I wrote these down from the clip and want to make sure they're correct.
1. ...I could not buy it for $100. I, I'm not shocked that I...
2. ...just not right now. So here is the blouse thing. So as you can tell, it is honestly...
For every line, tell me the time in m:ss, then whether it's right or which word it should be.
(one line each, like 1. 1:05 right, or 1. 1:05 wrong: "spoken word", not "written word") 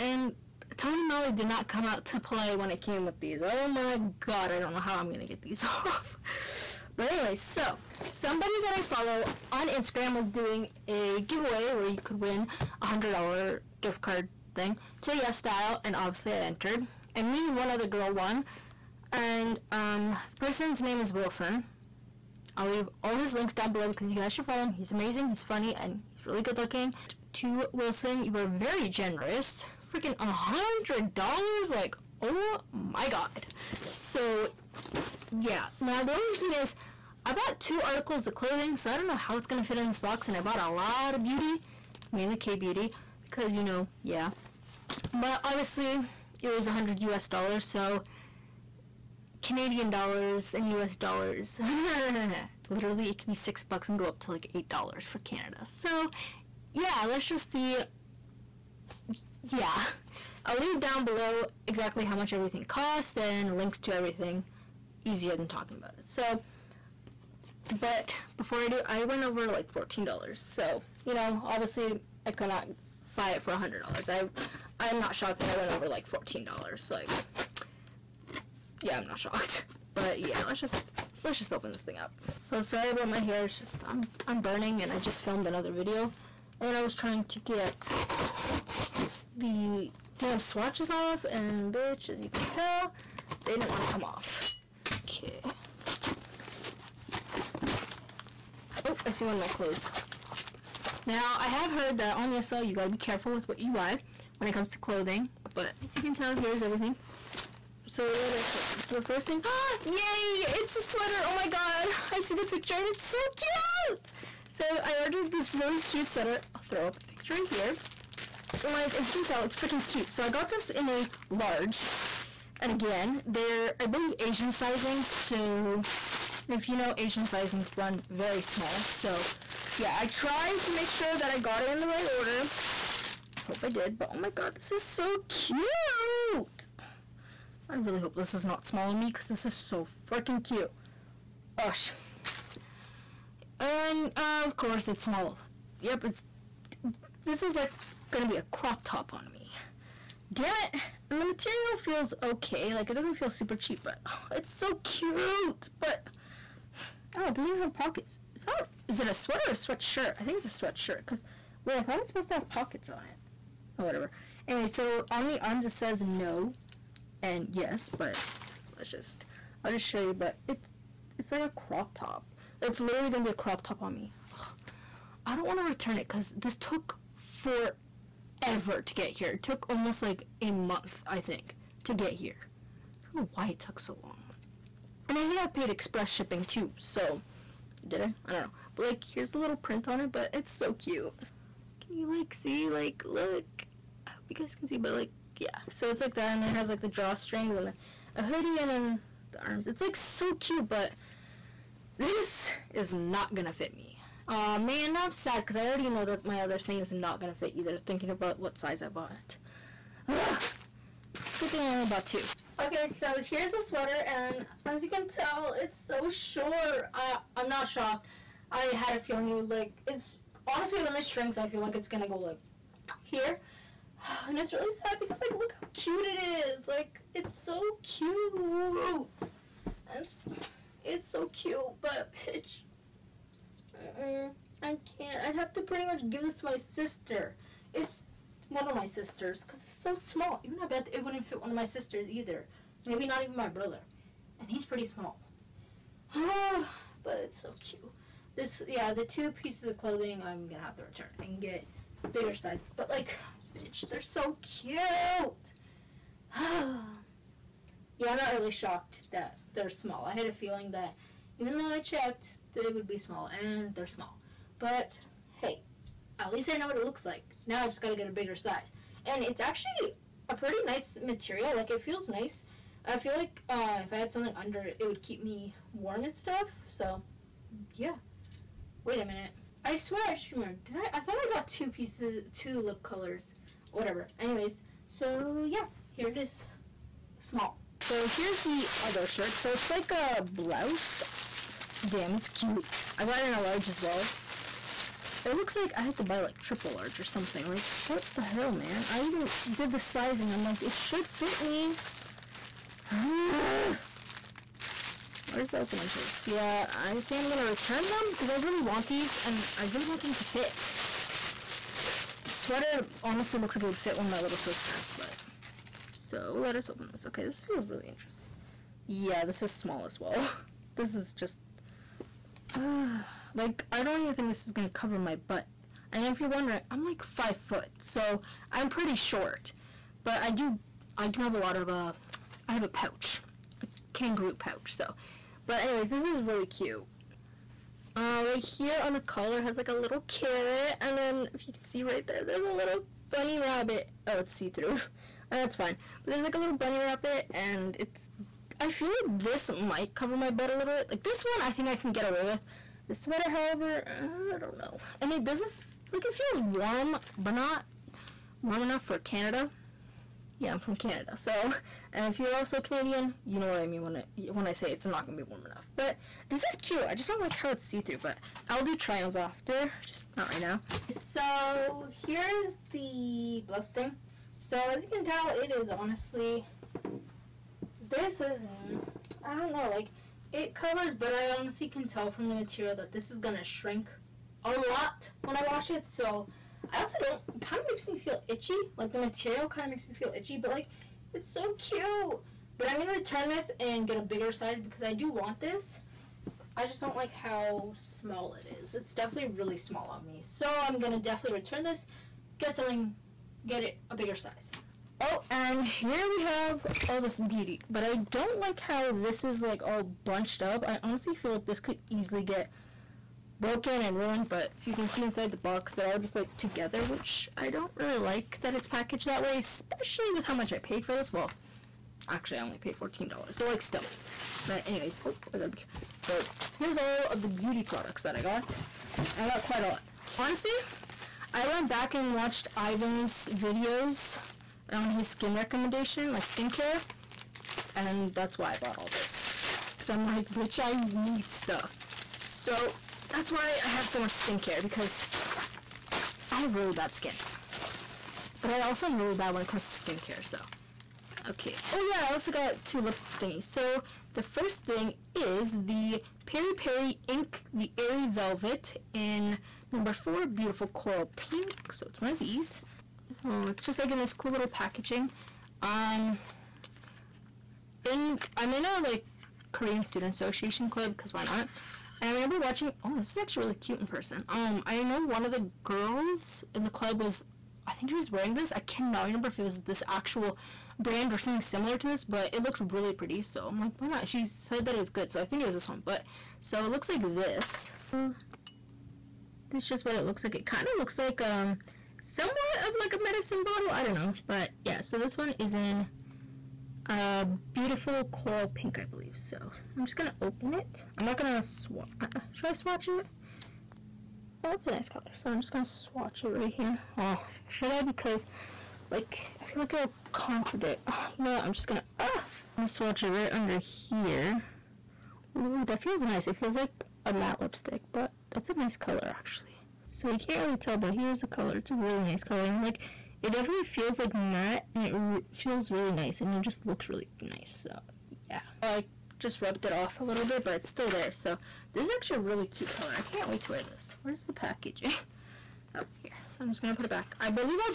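1. 1:12 right
2. 6:09 right.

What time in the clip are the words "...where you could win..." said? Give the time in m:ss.
0:11.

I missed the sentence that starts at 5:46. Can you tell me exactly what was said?
But there's like a little bunny rabbit, and it's...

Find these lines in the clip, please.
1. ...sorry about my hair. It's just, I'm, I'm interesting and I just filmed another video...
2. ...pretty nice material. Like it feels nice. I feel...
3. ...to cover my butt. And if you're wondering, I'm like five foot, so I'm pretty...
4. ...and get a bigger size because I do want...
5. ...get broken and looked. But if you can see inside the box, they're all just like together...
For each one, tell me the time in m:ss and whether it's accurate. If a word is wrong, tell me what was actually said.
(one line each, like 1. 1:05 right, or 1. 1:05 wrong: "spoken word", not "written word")
1. 1:22 wrong: "burning", not "interesting"
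2. 4:30 right
3. 5:24 right
4. 6:33 right
5. 6:52 wrong: "ruined", not "looked".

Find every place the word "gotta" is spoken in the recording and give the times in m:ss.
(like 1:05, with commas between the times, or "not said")
1:42, 4:27, 7:05.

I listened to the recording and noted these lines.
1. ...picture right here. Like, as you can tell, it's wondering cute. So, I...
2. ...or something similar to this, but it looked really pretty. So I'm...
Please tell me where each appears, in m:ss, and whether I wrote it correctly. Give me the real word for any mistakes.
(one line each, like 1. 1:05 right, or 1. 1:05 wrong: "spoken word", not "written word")
1. 1:57 wrong: "freaking", not "wondering"
2. 8:01 right.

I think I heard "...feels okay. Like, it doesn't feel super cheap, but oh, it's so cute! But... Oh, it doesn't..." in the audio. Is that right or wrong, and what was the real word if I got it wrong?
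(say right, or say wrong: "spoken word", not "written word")
right.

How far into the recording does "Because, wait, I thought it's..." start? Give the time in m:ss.
2:40.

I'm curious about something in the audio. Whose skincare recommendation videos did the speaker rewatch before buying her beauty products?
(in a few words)
Ivan.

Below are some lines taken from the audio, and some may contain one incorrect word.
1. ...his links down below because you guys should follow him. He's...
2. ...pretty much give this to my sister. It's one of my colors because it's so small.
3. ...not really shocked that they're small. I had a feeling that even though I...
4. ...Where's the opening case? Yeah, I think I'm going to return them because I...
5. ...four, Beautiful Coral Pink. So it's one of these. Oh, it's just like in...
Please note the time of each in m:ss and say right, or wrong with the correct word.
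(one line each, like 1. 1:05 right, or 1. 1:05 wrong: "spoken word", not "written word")
1. 0:23 right
2. 3:55 wrong: "sisters", not "colors"
3. 4:18 right
4. 5:05 right
5. 7:39 right.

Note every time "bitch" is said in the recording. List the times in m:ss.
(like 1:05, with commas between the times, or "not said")
1:31, 3:52, 4:13, 7:20.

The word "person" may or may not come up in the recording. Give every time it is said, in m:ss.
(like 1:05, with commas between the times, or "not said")
0:20, 7:53.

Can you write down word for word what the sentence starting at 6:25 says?
So I also don't, kind of makes me feel itchy.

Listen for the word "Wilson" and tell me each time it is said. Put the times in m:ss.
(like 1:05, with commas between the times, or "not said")
0:21, 0:27.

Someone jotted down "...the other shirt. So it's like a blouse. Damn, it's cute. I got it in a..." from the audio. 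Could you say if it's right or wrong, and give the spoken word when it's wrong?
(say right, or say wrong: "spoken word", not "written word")
right.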